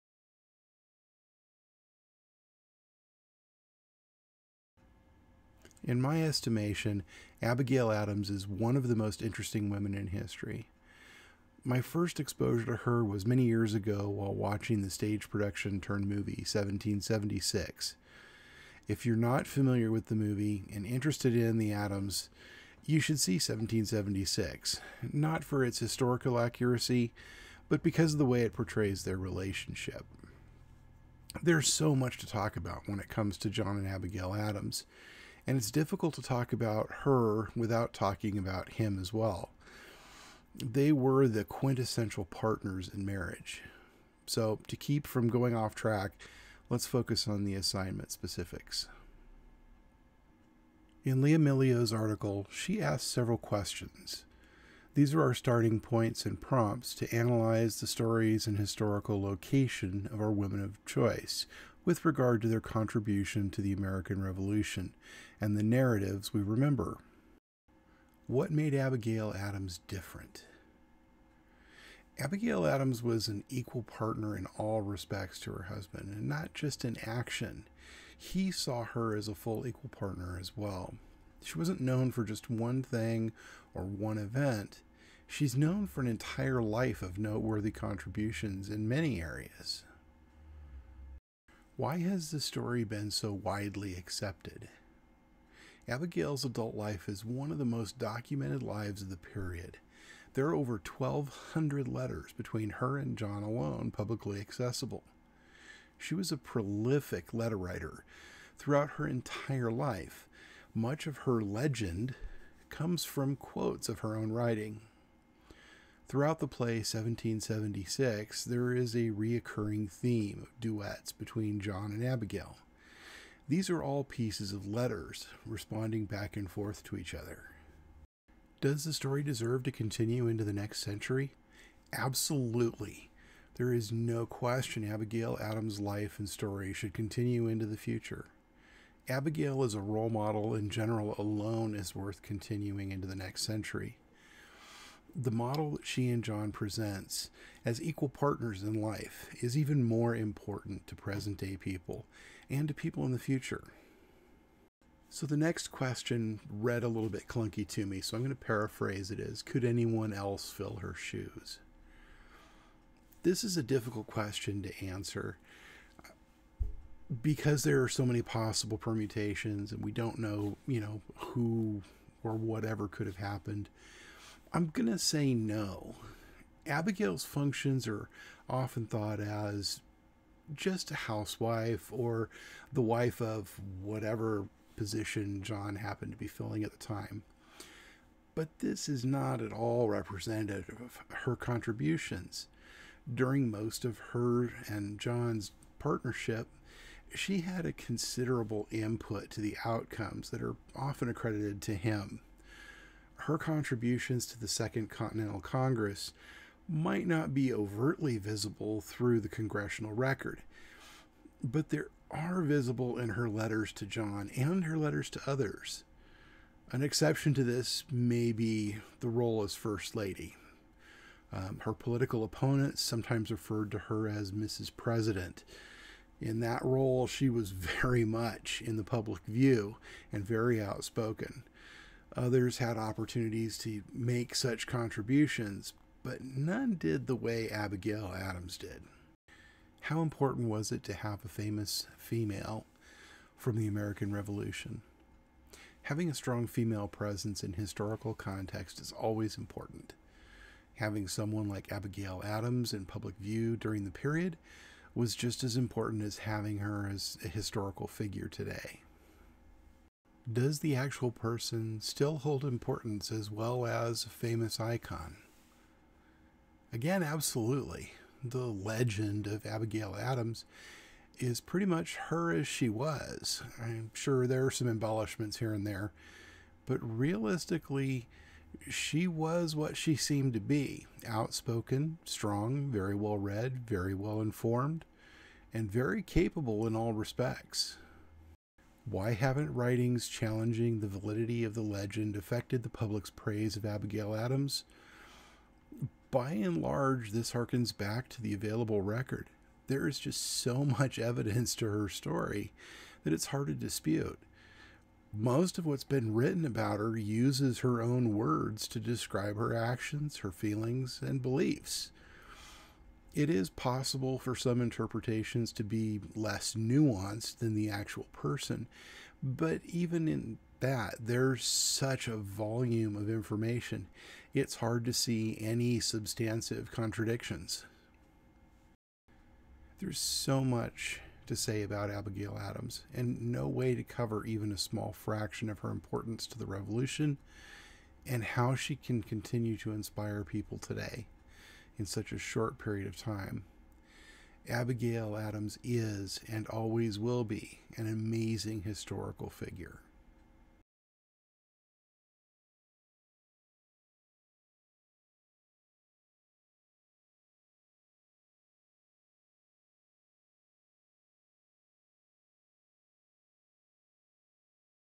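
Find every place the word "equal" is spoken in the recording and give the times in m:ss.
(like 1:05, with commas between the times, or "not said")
1:13, 1:19, 2:27.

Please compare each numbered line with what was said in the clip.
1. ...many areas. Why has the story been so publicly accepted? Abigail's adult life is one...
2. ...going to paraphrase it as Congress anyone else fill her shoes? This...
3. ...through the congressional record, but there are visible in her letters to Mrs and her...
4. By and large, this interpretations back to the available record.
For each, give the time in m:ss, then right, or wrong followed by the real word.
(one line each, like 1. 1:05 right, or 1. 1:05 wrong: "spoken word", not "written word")
1. 1:28 wrong: "widely", not "publicly"
2. 2:38 wrong: "Could", not "Congress"
3. 3:28 wrong: "John", not "Mrs"
4. 4:56 wrong: "harkens", not "interpretations".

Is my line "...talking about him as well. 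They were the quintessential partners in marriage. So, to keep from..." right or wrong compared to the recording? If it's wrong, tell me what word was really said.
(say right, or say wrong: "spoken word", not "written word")
right.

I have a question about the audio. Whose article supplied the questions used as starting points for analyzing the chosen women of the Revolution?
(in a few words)
Lea Millio.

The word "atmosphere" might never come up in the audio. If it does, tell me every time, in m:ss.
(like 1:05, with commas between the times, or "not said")
not said.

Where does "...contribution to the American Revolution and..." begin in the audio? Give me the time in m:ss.
1:02.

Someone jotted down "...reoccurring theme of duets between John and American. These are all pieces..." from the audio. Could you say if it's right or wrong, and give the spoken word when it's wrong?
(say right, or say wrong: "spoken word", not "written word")
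wrong: "Abigail", not "American".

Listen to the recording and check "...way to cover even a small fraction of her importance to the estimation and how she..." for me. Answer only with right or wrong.
wrong.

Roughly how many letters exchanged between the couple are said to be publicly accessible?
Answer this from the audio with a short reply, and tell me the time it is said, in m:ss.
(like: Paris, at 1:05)
Over 1,200, at 1:40.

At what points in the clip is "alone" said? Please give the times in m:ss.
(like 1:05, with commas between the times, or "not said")
1:43, 2:21.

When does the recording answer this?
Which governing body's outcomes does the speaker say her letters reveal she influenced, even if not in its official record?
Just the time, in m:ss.
3:24.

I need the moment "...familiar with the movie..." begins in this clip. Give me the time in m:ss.
0:19.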